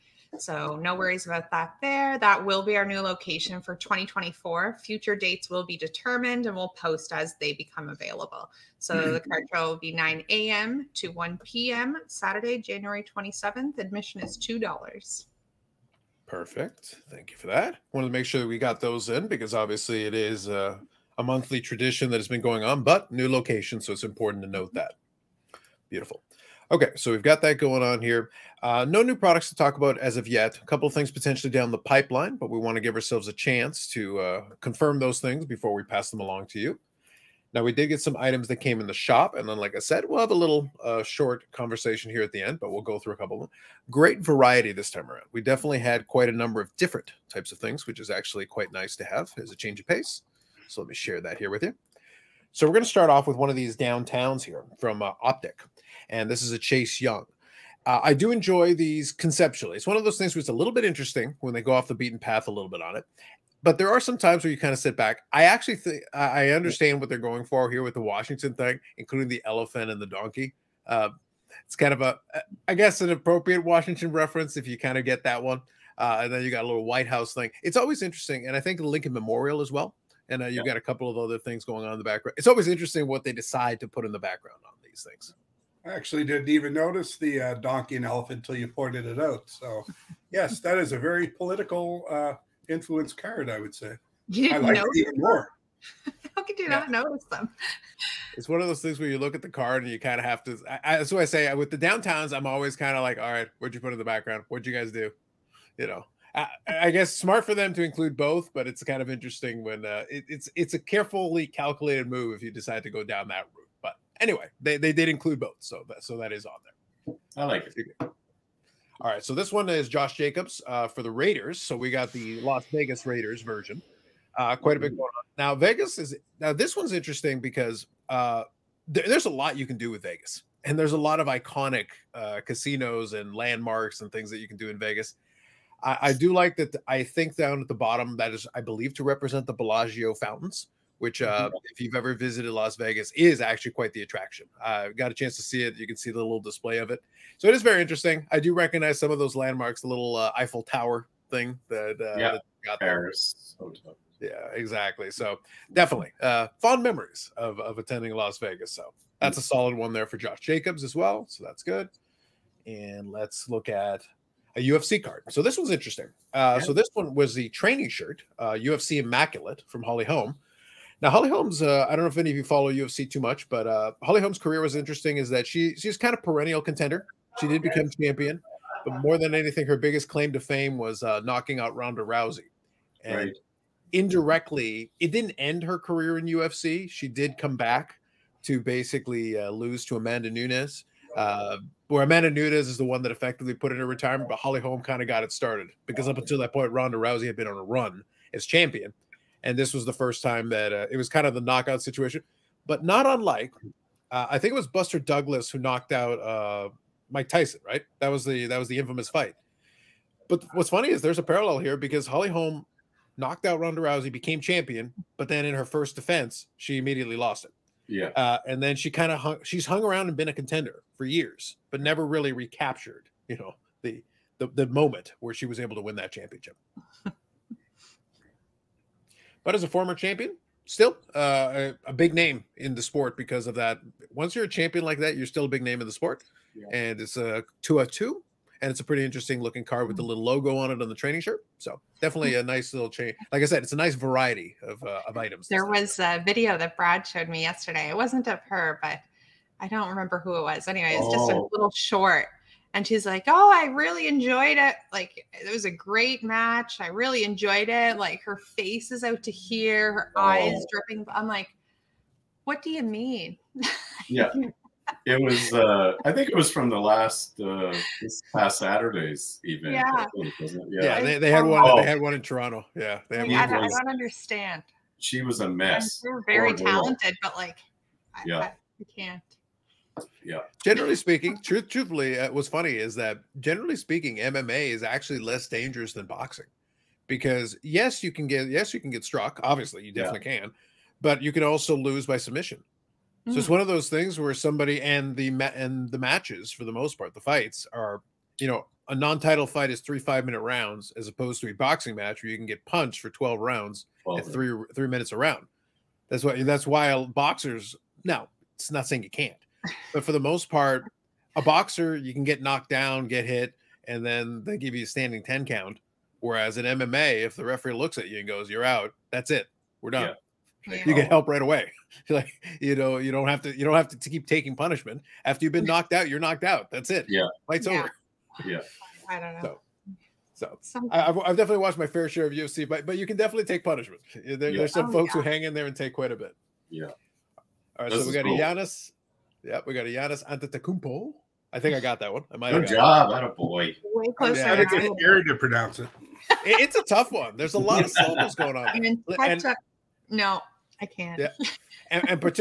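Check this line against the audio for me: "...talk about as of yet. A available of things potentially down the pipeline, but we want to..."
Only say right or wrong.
wrong.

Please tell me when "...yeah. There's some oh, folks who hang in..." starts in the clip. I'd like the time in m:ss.
5:34.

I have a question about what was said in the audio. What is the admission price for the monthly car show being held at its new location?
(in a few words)
$2.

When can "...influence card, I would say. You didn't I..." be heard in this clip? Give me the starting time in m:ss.
1:32.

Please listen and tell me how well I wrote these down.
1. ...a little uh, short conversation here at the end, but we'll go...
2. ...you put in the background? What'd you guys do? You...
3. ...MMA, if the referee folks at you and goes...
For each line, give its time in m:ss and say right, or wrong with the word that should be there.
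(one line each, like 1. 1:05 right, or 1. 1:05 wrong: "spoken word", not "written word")
1. 0:40 right
2. 1:43 right
3. 5:16 wrong: "looks", not "folks".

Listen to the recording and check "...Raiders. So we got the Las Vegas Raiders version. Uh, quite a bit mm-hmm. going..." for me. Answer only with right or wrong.
right.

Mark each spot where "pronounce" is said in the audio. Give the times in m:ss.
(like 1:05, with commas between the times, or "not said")
5:45.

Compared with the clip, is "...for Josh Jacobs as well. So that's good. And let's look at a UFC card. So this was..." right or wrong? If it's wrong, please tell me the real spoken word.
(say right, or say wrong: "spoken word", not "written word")
right.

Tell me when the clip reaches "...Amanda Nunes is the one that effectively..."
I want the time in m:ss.
3:12.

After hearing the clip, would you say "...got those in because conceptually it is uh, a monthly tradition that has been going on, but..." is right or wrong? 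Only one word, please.
wrong.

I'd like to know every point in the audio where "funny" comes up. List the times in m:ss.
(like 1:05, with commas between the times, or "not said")
3:30, 4:42.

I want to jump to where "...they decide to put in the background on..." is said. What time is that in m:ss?
1:23.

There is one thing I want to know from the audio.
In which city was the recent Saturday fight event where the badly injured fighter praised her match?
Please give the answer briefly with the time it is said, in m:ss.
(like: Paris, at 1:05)
Toronto, at 4:32.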